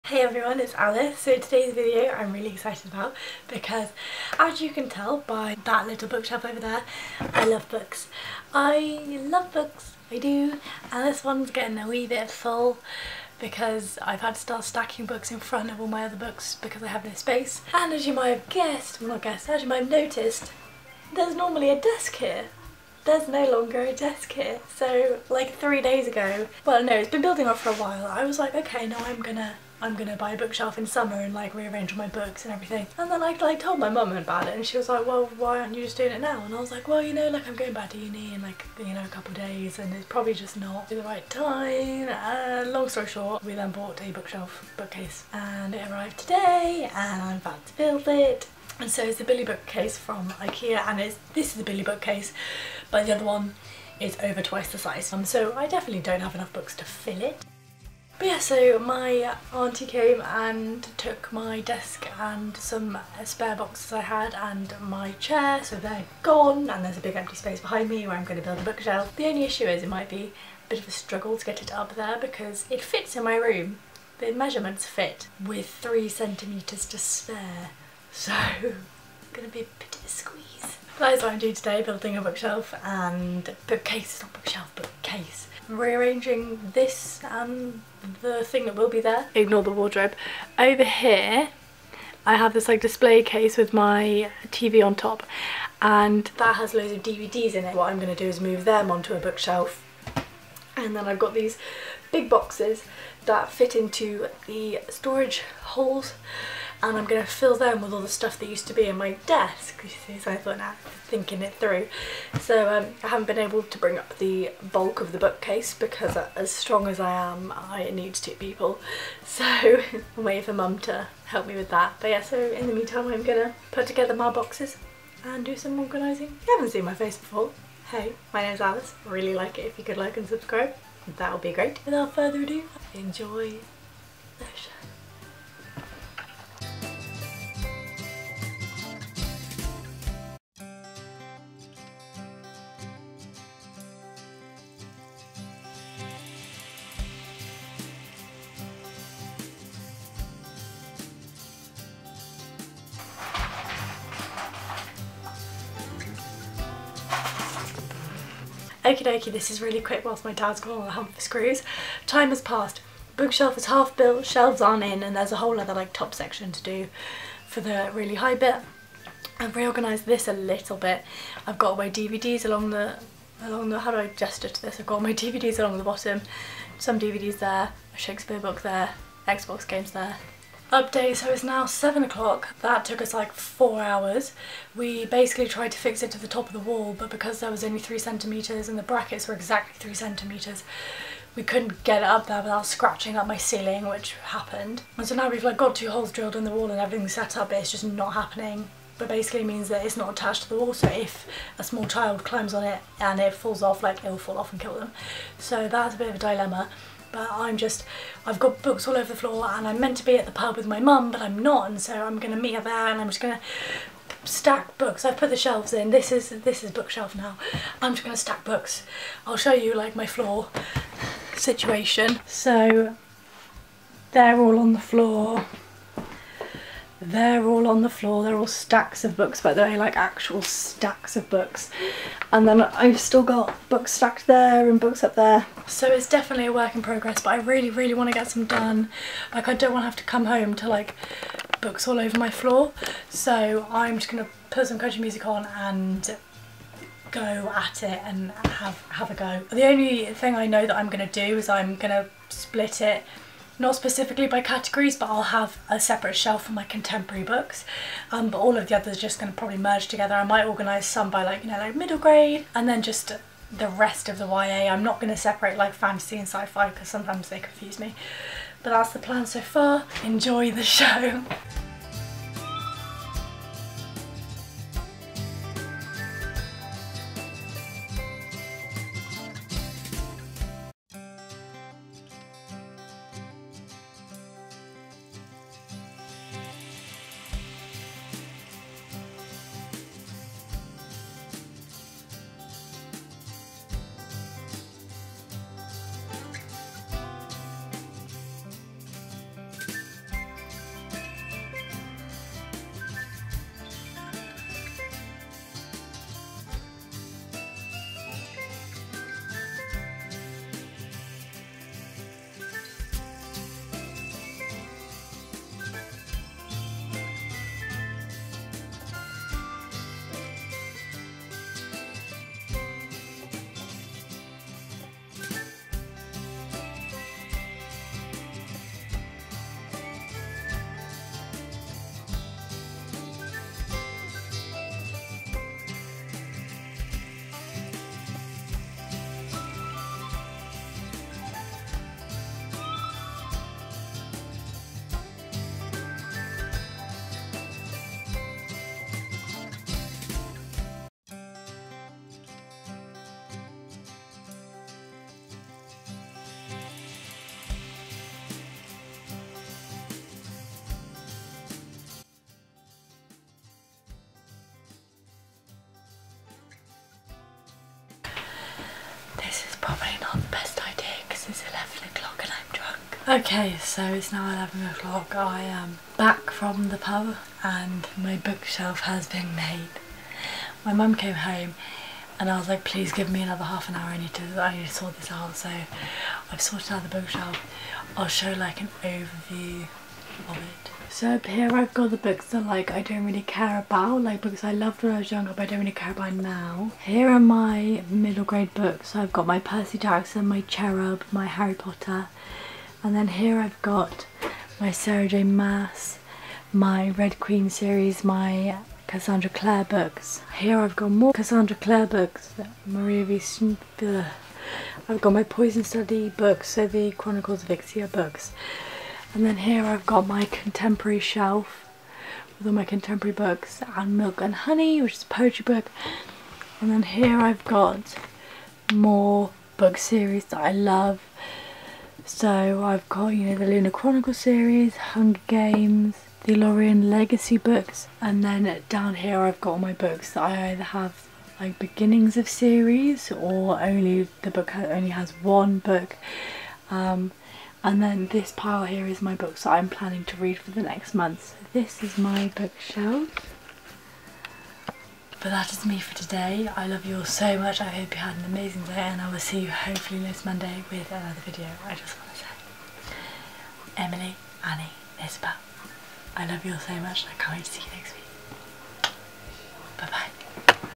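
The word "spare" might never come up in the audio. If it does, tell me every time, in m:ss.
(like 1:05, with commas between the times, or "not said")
1:03, 1:16.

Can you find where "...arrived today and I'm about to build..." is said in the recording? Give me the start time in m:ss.
0:45.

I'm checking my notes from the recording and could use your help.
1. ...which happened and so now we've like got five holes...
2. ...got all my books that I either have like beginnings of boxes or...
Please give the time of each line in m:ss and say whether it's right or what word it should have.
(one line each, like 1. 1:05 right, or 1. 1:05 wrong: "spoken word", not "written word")
1. 3:13 wrong: "two", not "five"
2. 7:19 wrong: "series", not "boxes".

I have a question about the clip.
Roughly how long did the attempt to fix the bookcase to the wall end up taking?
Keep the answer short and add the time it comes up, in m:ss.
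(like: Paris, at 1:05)
4 hours, at 3:03.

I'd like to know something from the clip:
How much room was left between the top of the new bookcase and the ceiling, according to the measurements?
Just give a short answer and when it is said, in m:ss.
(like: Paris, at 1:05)
3 centimetres, at 1:15.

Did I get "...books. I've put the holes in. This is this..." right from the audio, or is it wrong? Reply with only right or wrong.
wrong.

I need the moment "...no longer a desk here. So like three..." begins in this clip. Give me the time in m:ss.
0:23.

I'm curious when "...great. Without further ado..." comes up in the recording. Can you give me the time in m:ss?
2:11.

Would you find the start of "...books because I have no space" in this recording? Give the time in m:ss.
0:16.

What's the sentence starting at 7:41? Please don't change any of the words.
I just want to say, Emily, Annie, Isabel, I love you all so much.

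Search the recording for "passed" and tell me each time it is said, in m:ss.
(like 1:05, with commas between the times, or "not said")
2:42.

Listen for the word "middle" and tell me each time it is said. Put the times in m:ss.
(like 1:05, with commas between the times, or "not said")
4:21, 6:37.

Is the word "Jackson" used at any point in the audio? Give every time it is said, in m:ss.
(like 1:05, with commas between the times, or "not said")
6:39.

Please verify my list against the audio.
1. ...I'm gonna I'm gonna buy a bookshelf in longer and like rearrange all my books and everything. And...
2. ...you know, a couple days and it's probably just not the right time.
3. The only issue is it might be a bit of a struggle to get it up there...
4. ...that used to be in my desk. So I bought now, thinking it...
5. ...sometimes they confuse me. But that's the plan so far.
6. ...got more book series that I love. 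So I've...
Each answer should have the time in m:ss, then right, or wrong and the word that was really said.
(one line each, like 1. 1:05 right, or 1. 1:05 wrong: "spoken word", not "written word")
1. 0:29 wrong: "summer", not "longer"
2. 0:38 right
3. 1:09 right
4. 1:48 wrong: "thought", not "bought"
5. 4:26 right
6. 7:07 right.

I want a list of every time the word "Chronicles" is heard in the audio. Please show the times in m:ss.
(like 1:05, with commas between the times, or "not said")
6:56, 7:13.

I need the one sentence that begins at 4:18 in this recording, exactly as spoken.
Um, but all of the others are just going to probably merge together.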